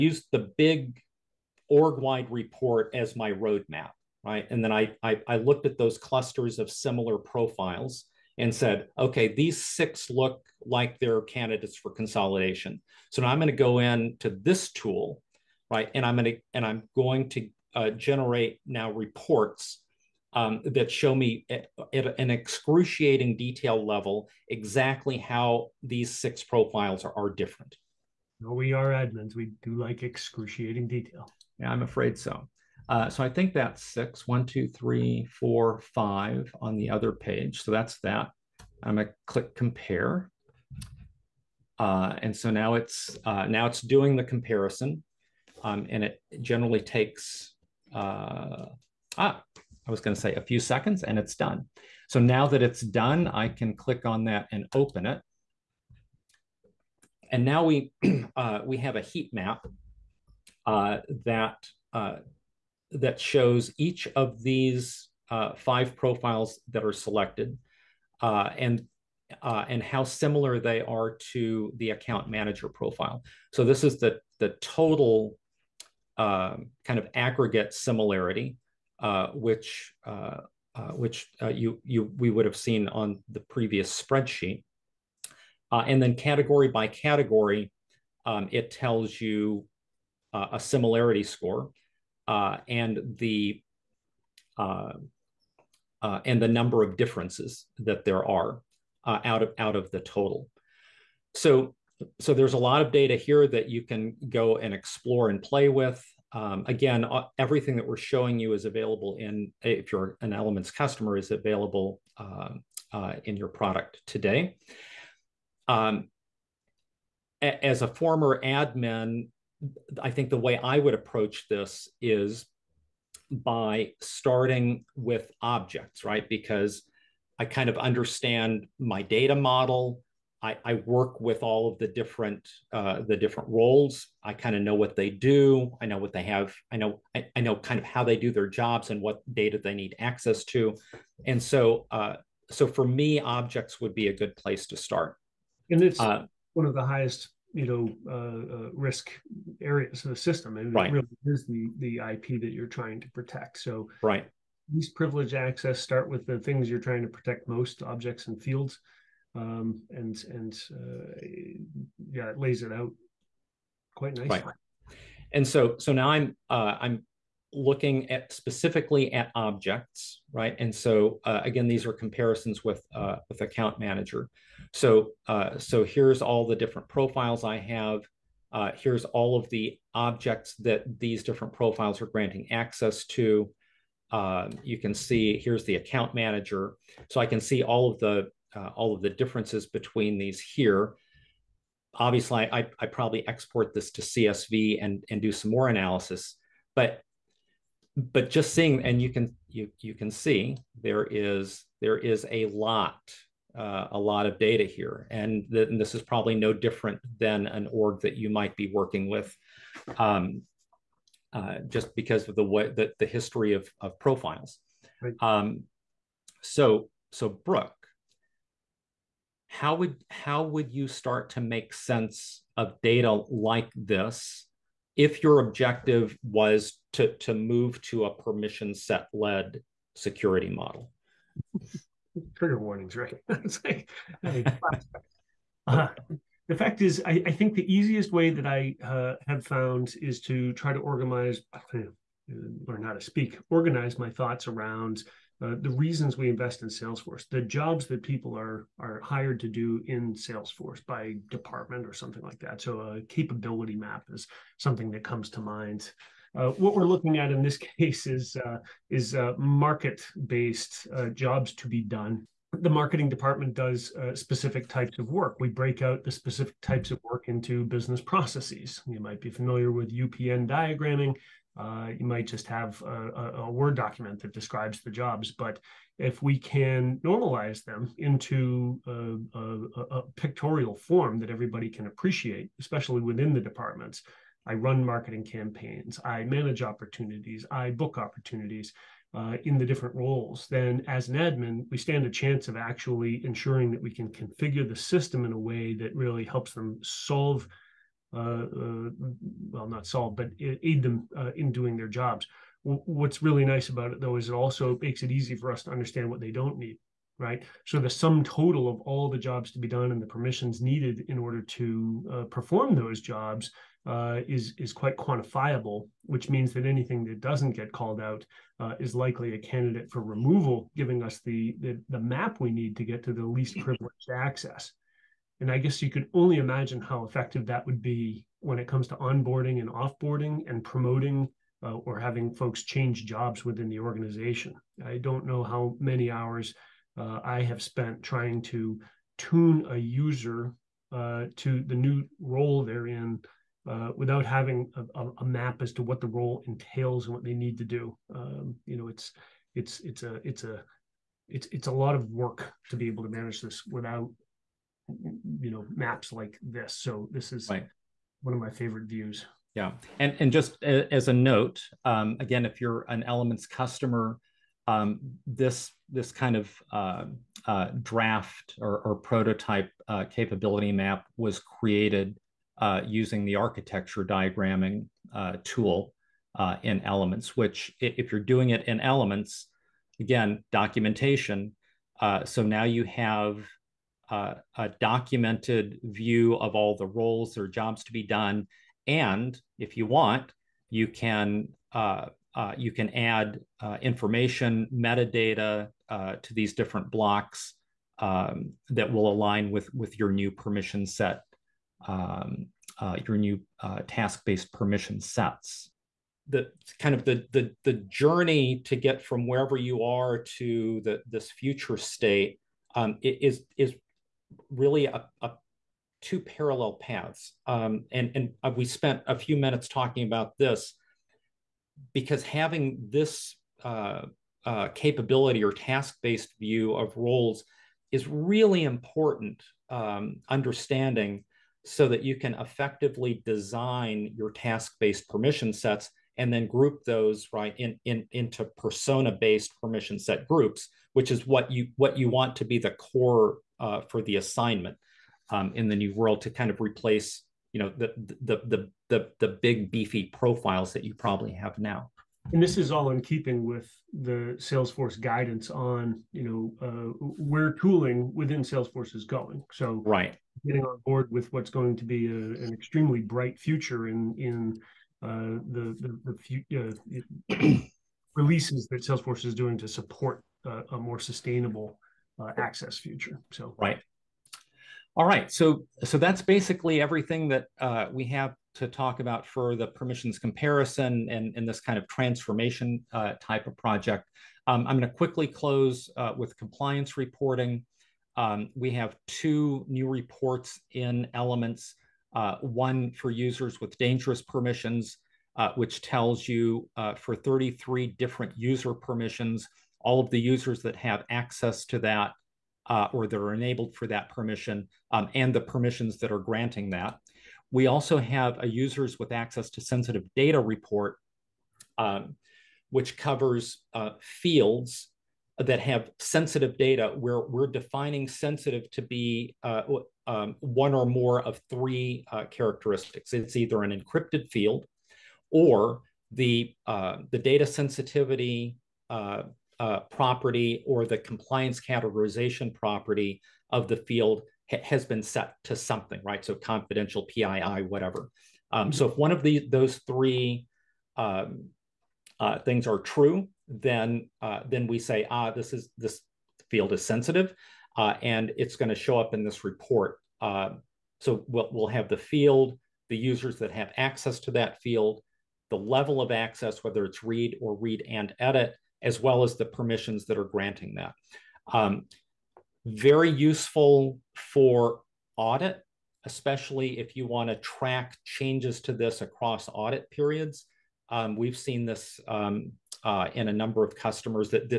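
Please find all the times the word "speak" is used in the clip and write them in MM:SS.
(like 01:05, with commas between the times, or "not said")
04:03.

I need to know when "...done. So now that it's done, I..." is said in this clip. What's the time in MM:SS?
00:51.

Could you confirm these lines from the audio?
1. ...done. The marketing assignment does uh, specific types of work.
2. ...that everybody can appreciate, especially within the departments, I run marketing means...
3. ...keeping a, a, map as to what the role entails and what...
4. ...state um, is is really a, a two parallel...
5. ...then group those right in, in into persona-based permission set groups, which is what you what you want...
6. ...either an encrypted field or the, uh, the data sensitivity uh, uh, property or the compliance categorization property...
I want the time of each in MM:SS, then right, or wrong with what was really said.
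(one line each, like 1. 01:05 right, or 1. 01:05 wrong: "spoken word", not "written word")
1. 04:21 wrong: "department", not "assignment"
2. 04:41 wrong: "campaigns", not "means"
3. 05:44 wrong: "having", not "keeping"
4. 06:51 right
5. 07:16 right
6. 08:43 right.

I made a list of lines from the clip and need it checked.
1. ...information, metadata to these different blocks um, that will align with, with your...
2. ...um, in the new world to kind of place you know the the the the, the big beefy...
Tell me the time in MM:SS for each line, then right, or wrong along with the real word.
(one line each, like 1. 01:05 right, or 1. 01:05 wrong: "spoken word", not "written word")
1. 06:33 right
2. 07:25 wrong: "replace", not "place".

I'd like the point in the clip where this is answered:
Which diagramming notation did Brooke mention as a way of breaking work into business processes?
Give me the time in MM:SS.
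04:29.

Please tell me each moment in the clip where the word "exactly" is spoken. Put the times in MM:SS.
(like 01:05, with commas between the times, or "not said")
00:24.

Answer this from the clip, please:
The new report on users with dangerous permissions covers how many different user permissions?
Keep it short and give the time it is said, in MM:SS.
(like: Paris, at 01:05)
33, at 08:17.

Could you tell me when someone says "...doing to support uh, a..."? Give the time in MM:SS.
07:49.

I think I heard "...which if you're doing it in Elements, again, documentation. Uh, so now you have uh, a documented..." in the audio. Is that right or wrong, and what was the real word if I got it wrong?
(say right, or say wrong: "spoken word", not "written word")
right.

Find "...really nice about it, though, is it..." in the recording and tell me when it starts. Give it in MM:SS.
05:03.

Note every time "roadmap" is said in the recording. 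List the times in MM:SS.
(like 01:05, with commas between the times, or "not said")
00:03.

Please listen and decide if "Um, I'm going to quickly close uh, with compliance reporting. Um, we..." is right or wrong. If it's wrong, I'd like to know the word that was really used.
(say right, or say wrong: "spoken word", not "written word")
right.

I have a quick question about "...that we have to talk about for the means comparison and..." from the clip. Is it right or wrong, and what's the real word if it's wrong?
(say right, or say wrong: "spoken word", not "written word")
wrong: "permissions", not "means".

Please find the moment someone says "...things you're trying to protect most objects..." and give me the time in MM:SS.
02:36.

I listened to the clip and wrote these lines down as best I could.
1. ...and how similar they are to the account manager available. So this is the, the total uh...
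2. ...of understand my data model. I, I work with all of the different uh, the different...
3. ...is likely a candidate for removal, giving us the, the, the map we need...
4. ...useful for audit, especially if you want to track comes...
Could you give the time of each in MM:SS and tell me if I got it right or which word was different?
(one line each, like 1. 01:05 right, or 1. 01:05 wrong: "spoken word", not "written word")
1. 01:09 wrong: "profile", not "available"
2. 02:07 right
3. 05:18 right
4. 09:23 wrong: "changes", not "comes".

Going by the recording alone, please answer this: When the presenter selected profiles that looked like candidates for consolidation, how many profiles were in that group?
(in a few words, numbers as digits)
6.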